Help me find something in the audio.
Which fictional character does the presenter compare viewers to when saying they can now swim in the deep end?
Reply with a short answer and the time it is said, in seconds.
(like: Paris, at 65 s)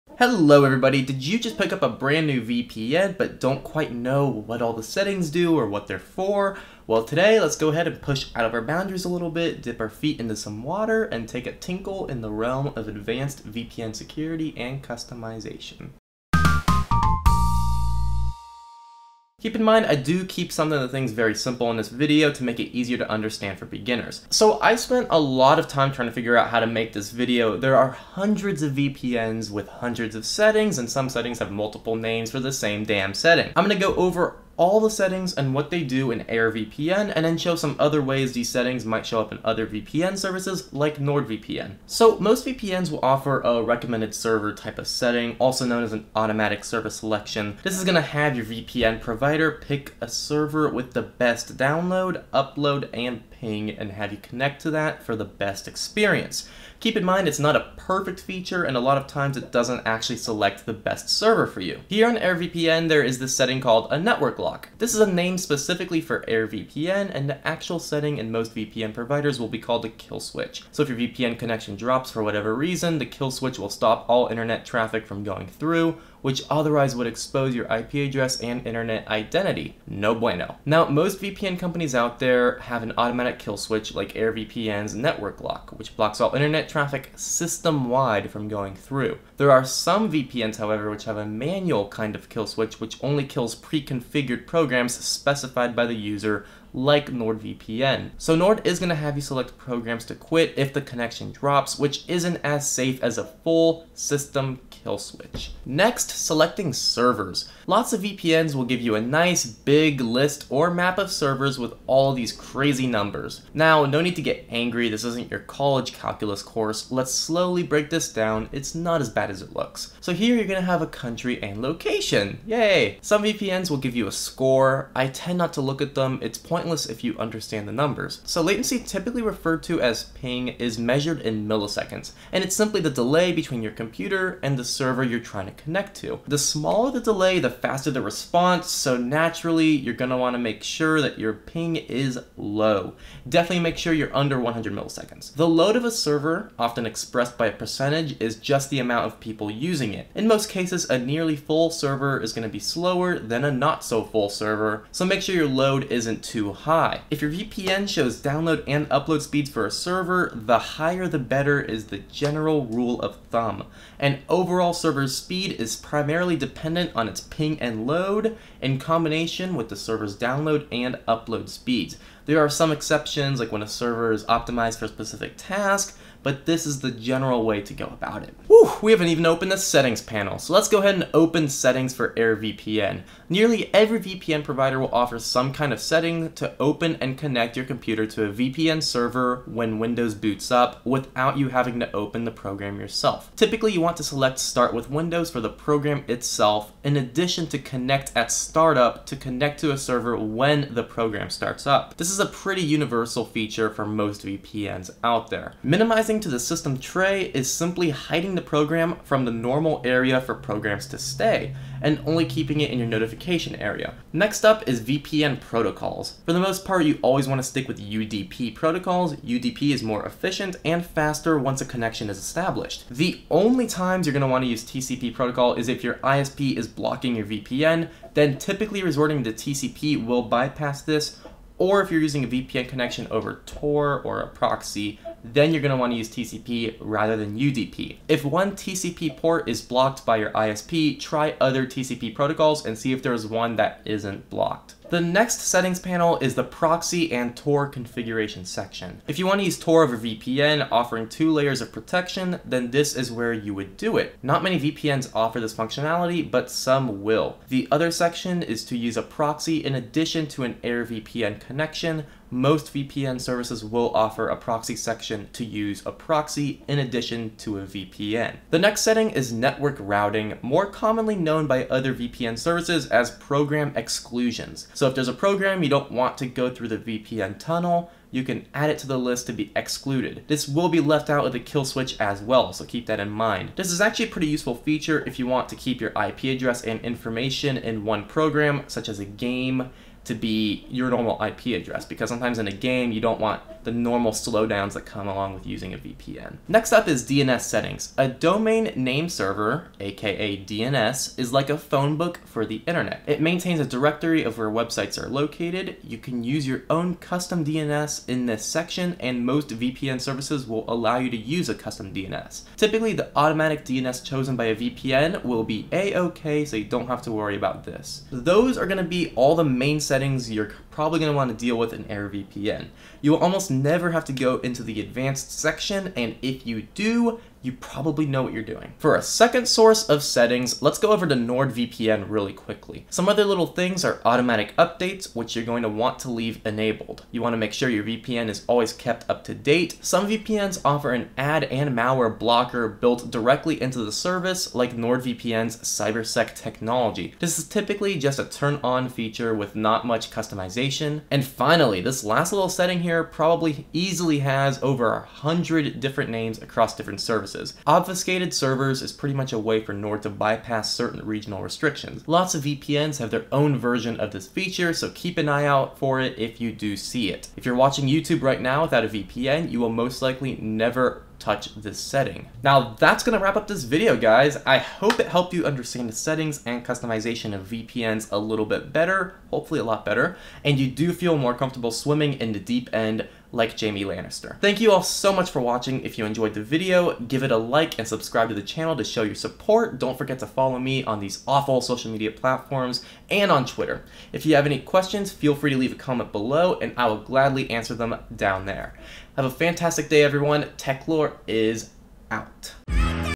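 Jaime Lannister, at 383 s.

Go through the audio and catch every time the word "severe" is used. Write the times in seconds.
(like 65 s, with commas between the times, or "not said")
not said.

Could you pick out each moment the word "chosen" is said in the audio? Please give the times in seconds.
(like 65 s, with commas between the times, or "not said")
314 s.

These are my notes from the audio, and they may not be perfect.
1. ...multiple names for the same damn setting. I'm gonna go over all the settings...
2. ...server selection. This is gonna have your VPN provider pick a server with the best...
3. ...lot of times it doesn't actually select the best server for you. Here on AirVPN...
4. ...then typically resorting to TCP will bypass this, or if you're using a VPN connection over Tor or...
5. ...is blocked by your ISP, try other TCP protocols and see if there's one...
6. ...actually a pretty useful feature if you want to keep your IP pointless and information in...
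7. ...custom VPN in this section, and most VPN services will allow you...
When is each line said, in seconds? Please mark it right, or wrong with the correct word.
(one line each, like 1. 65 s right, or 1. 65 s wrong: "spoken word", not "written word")
1. 31 s right
2. 46 s right
3. 58 s right
4. 228 s right
5. 239 s right
6. 283 s wrong: "address", not "pointless"
7. 306 s wrong: "DNS", not "VPN".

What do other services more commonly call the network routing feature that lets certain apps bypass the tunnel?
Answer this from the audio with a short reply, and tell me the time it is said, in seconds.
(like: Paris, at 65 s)
Program exclusions, at 273 s.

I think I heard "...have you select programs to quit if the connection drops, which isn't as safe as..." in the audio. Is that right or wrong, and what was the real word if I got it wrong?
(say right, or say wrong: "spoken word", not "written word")
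right.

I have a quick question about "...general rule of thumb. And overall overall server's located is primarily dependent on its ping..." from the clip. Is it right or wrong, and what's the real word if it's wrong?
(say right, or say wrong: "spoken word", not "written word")
wrong: "speed", not "located".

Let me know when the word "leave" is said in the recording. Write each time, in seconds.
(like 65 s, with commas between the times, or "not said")
336 s, 395 s.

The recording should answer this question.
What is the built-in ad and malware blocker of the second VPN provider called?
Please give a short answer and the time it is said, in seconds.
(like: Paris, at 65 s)
CyberSec, at 345 s.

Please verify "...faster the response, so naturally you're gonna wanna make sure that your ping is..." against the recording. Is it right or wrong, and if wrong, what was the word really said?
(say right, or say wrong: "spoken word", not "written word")
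right.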